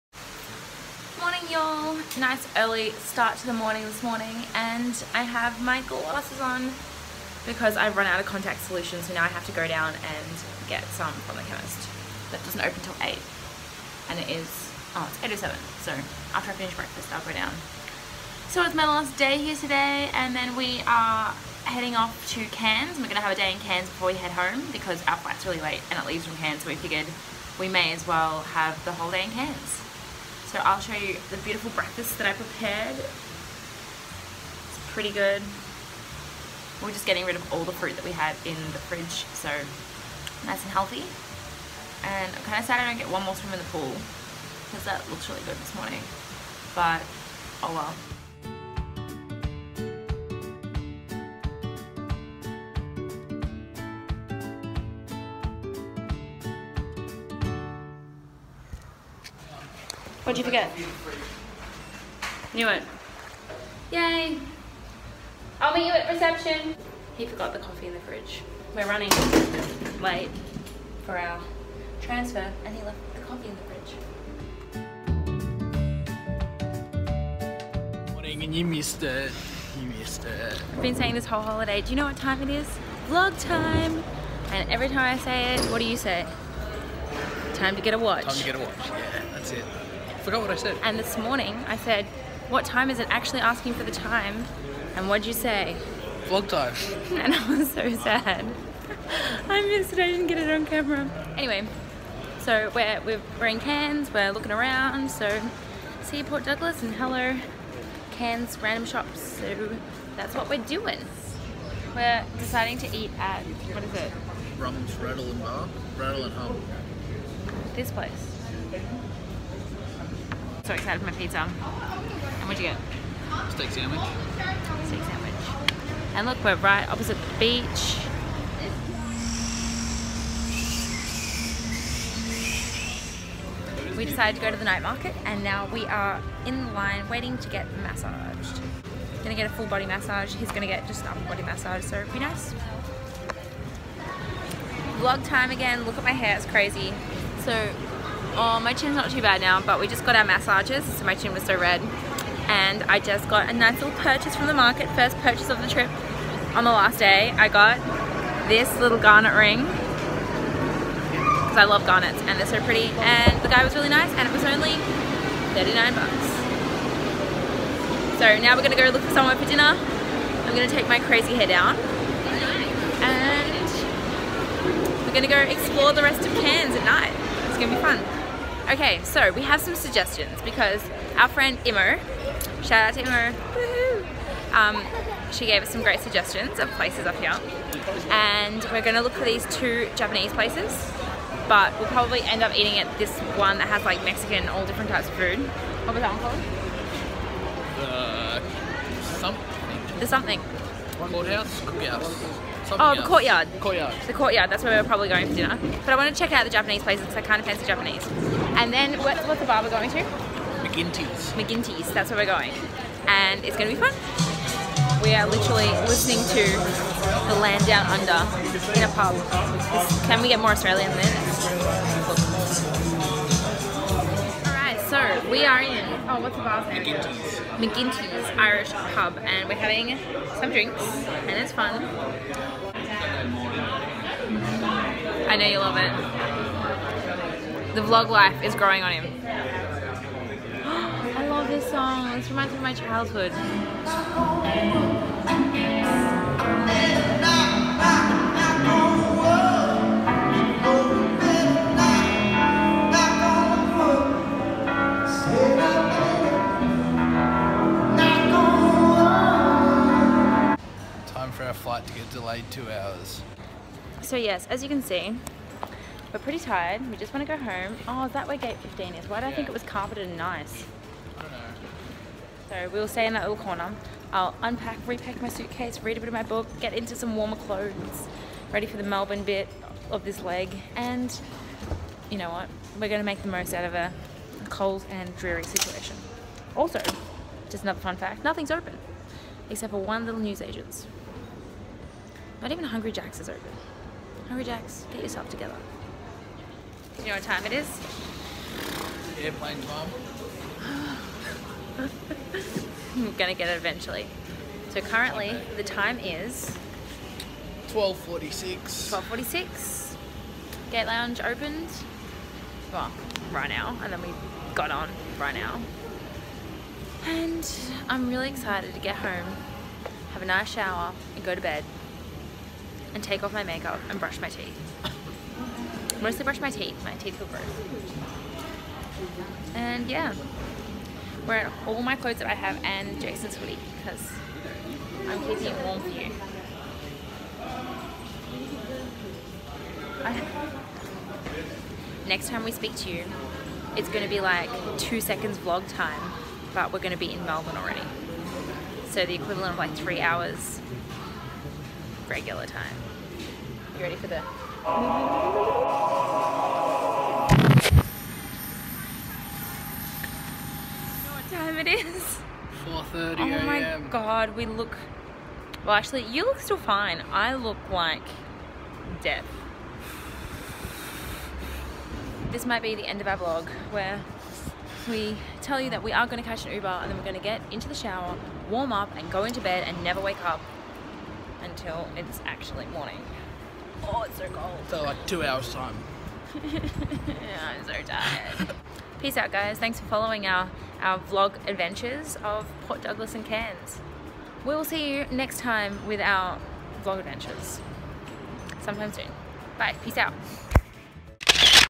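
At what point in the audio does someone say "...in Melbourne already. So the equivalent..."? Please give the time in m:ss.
5:47.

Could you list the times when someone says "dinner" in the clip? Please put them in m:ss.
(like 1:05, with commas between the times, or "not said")
2:49, 3:25.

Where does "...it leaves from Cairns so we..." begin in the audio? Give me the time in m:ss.
0:25.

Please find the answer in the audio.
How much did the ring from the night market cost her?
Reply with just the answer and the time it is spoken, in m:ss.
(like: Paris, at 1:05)
$39, at 2:45.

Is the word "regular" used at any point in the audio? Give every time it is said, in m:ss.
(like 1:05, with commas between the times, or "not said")
5:52.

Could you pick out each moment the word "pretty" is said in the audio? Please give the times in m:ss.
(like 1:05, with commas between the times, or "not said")
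0:34, 2:42, 4:26.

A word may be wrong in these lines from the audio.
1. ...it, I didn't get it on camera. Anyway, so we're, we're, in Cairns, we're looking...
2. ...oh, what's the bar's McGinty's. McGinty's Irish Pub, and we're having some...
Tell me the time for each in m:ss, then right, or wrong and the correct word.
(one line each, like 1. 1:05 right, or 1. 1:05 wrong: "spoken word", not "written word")
1. 1:39 right
2. 3:46 right.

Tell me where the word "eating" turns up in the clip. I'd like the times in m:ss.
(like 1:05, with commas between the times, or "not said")
3:12.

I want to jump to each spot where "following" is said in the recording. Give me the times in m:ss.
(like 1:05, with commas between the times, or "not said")
6:29.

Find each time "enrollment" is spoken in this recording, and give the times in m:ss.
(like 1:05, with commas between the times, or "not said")
not said.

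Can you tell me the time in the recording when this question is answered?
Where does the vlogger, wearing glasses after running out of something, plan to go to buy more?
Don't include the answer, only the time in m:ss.
0:11.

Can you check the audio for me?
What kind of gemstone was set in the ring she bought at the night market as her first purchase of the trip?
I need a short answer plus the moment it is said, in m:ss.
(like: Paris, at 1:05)
Garnet, at 2:38.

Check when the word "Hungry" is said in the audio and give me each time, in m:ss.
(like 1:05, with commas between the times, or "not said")
4:52.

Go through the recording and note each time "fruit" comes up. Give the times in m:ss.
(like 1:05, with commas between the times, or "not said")
0:37.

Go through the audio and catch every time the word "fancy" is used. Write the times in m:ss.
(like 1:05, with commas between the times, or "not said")
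3:27.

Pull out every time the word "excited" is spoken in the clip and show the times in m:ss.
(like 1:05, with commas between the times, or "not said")
2:00, 5:18.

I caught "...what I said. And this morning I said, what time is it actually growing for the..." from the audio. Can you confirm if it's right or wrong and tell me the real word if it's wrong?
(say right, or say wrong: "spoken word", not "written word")
wrong: "asking", not "growing".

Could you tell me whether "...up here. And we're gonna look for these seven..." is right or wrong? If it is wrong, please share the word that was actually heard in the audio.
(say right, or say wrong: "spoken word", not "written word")
wrong: "two", not "seven".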